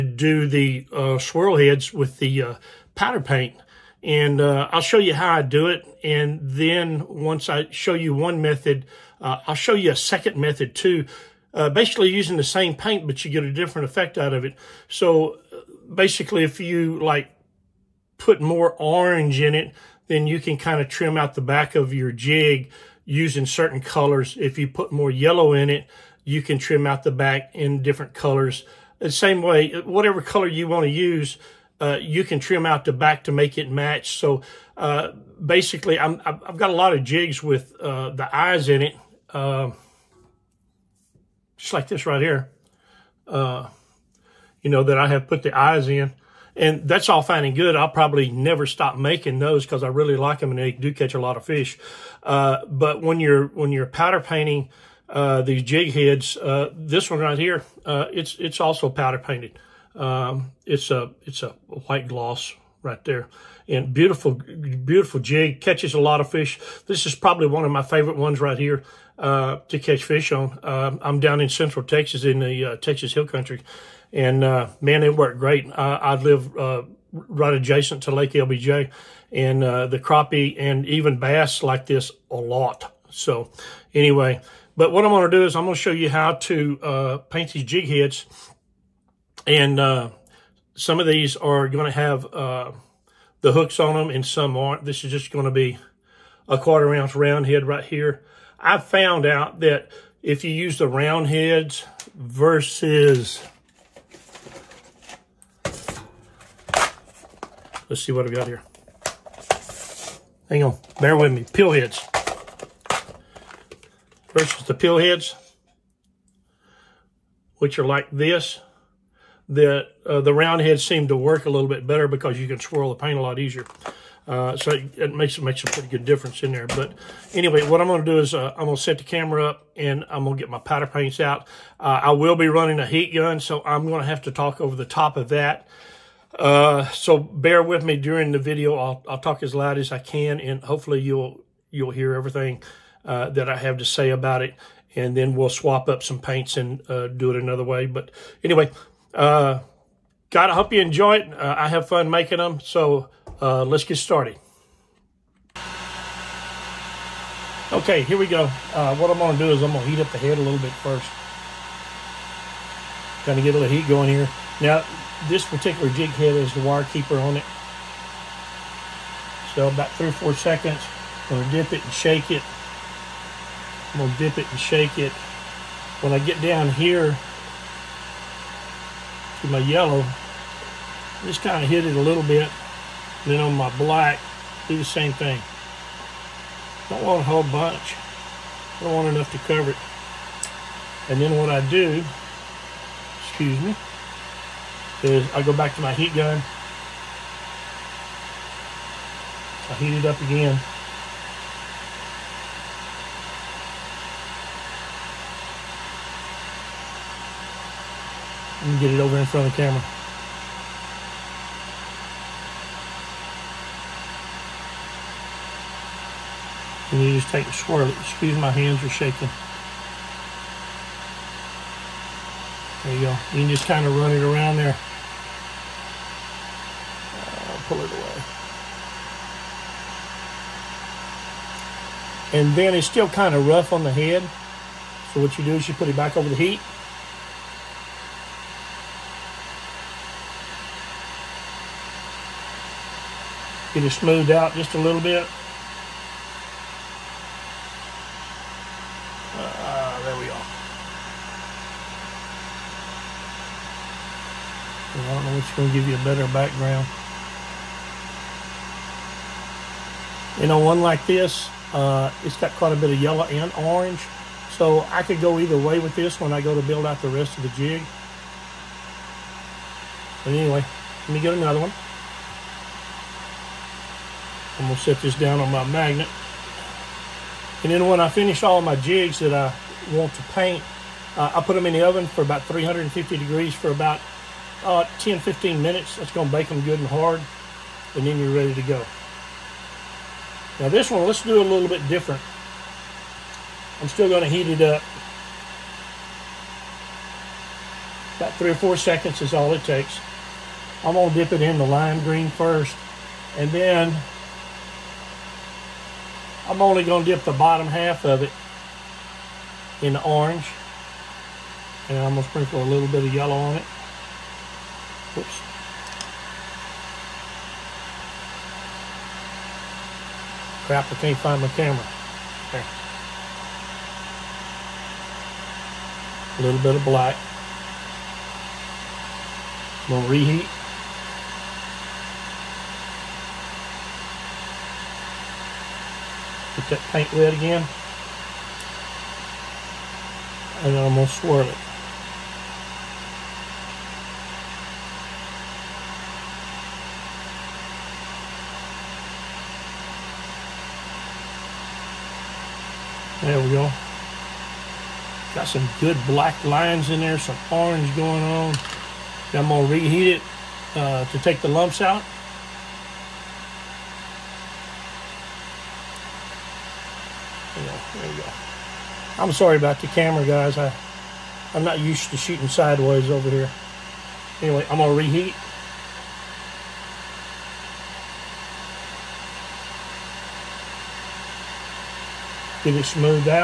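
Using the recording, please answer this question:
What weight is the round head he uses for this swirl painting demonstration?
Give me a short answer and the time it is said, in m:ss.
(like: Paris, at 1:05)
Quarter ounce, at 1:36.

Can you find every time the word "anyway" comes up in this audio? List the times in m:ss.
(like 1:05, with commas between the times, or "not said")
1:23, 2:07, 2:28, 4:30, 6:14.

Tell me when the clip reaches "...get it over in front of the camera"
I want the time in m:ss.
3:28.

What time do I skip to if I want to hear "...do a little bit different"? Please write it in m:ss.
4:51.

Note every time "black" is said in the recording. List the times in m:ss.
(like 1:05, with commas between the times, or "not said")
3:03, 5:26, 5:56.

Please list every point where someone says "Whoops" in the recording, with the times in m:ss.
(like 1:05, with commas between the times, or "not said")
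5:15.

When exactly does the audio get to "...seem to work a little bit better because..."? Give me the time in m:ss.
2:00.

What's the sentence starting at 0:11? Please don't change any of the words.
basically using the same paint, but you get a different effect out of it.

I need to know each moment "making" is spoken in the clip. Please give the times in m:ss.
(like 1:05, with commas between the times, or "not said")
0:48, 2:32.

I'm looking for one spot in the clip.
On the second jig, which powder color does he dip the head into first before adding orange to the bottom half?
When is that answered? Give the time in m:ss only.
5:01.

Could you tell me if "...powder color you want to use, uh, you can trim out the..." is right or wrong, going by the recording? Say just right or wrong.
wrong.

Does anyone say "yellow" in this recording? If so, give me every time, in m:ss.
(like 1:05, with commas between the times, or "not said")
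0:25, 2:59, 4:22, 5:13.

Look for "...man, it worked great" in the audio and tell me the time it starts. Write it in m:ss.
1:14.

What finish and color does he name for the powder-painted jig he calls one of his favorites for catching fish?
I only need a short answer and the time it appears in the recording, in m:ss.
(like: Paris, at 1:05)
White gloss, at 1:01.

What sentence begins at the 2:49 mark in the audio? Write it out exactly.
So about three or four seconds, I'm gonna dip it and shake it.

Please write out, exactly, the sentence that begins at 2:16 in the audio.
Uh, so bear with me during the video.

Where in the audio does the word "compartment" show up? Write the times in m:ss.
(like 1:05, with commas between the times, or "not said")
not said.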